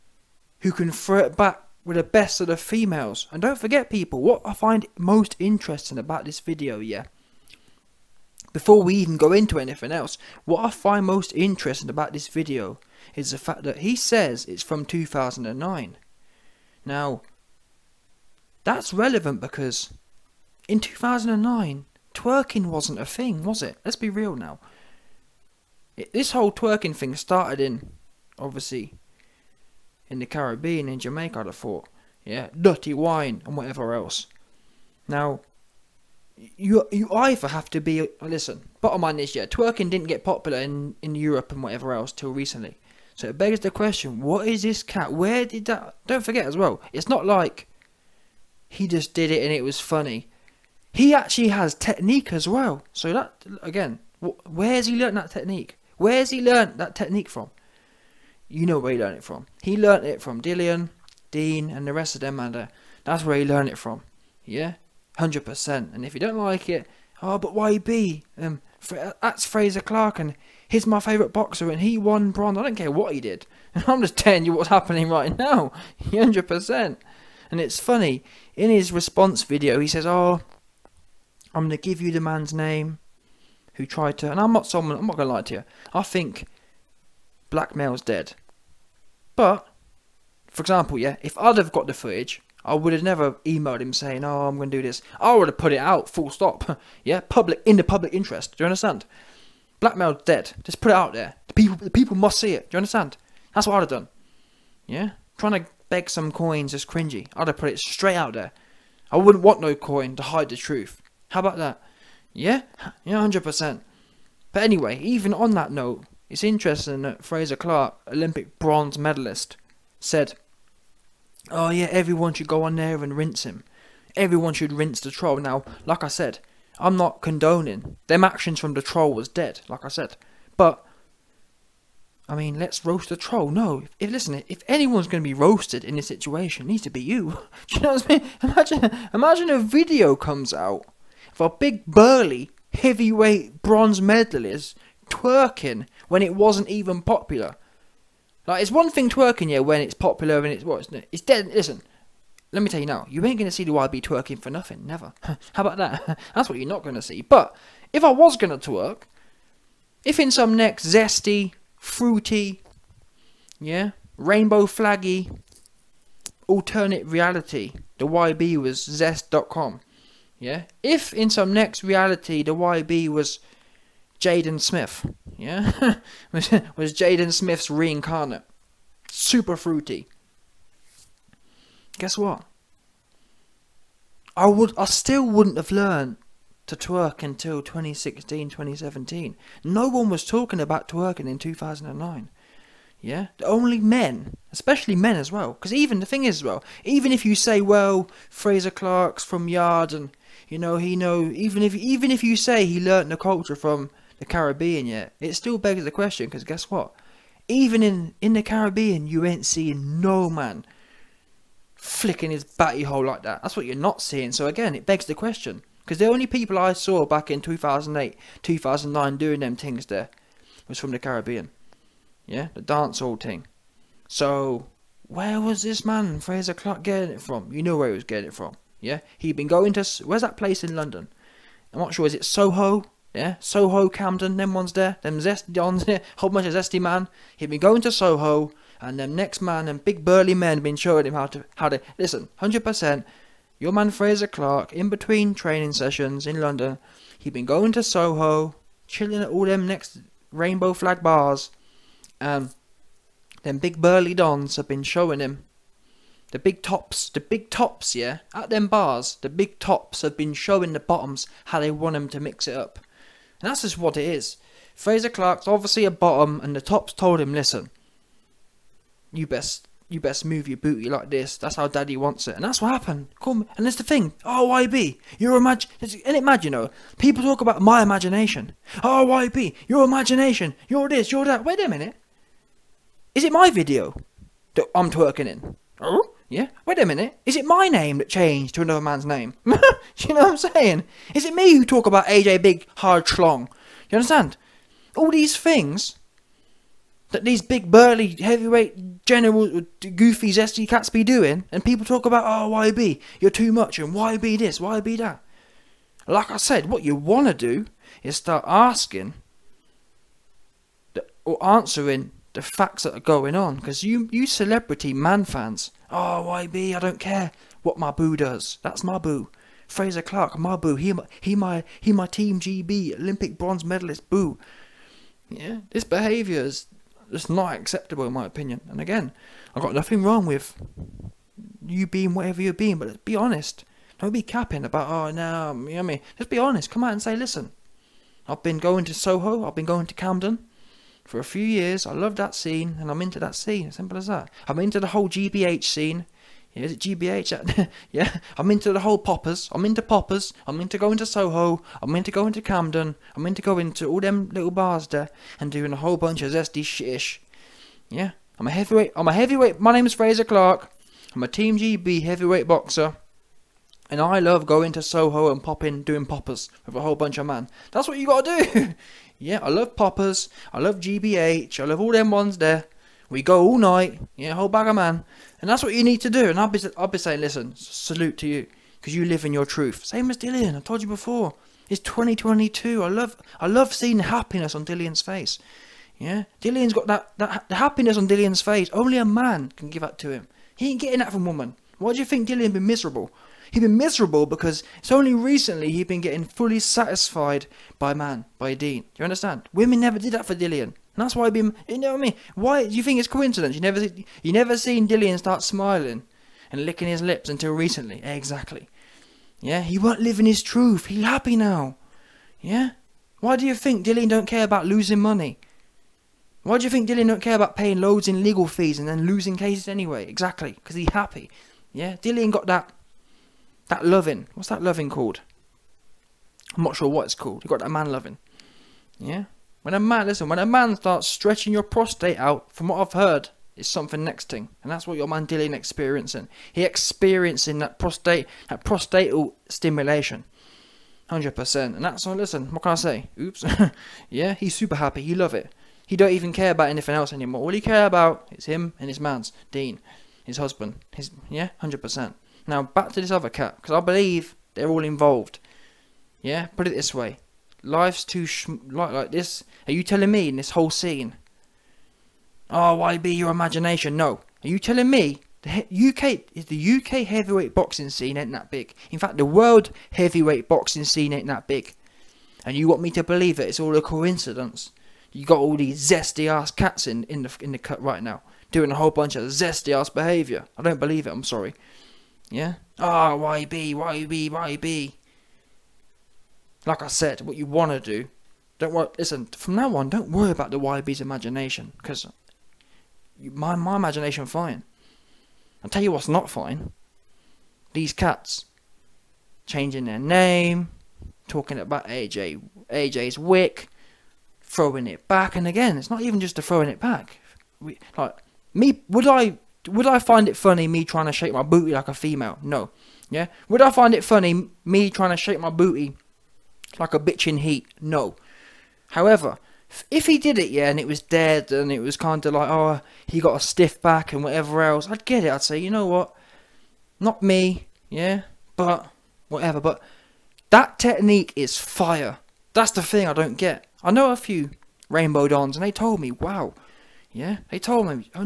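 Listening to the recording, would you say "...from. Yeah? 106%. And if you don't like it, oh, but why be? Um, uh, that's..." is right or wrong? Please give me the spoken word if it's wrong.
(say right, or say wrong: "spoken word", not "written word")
wrong: "100", not "106".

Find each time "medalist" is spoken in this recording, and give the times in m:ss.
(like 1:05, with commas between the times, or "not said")
1:58, 2:23, 5:23.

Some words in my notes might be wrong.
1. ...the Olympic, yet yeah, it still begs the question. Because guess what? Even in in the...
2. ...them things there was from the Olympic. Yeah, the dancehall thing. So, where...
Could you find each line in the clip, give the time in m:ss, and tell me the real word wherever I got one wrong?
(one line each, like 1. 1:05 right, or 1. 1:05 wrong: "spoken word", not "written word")
1. 3:24 wrong: "Caribbean", not "Olympic"
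2. 3:39 wrong: "Caribbean", not "Olympic".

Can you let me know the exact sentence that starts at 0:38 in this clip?
Bottom line is, yeah, twerking didn't get popular in in Europe and whatever else till recently.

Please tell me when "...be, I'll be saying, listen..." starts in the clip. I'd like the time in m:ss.
6:16.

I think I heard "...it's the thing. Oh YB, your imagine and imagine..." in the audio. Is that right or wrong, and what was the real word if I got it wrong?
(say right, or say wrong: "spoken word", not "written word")
right.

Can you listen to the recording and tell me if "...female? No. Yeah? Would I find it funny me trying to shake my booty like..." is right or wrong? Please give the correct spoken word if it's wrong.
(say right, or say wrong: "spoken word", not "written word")
right.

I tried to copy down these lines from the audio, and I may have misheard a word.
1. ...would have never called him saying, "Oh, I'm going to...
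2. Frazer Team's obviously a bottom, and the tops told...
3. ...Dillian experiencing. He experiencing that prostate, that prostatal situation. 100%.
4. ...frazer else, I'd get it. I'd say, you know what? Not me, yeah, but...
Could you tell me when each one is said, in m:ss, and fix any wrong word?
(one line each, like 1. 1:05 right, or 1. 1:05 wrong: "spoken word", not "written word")
1. 1:32 wrong: "emailed", not "called"
2. 4:24 wrong: "Clarke", not "Team"
3. 7:15 wrong: "stimulation", not "situation"
4. 8:44 wrong: "whatever", not "frazer".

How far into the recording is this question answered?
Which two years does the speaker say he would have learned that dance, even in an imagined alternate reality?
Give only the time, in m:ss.
3:07.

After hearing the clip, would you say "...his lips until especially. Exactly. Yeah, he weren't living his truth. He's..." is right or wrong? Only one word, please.
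wrong.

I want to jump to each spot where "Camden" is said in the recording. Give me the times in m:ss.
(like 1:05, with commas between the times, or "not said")
3:53, 5:39, 5:52.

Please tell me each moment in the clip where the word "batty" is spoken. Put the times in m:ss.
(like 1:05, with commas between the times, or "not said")
3:32.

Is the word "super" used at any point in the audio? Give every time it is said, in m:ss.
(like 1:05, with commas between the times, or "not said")
2:59, 7:24.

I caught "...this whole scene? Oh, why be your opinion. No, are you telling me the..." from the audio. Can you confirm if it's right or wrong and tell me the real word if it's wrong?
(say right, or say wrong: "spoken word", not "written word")
wrong: "imagination", not "opinion".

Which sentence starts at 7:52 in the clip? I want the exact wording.
And you want me to believe that it's all a coincidence?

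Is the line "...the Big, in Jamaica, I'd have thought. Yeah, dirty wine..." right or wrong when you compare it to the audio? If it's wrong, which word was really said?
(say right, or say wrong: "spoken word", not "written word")
wrong: "Caribbean", not "Big".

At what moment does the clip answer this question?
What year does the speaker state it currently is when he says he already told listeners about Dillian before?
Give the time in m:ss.
6:21.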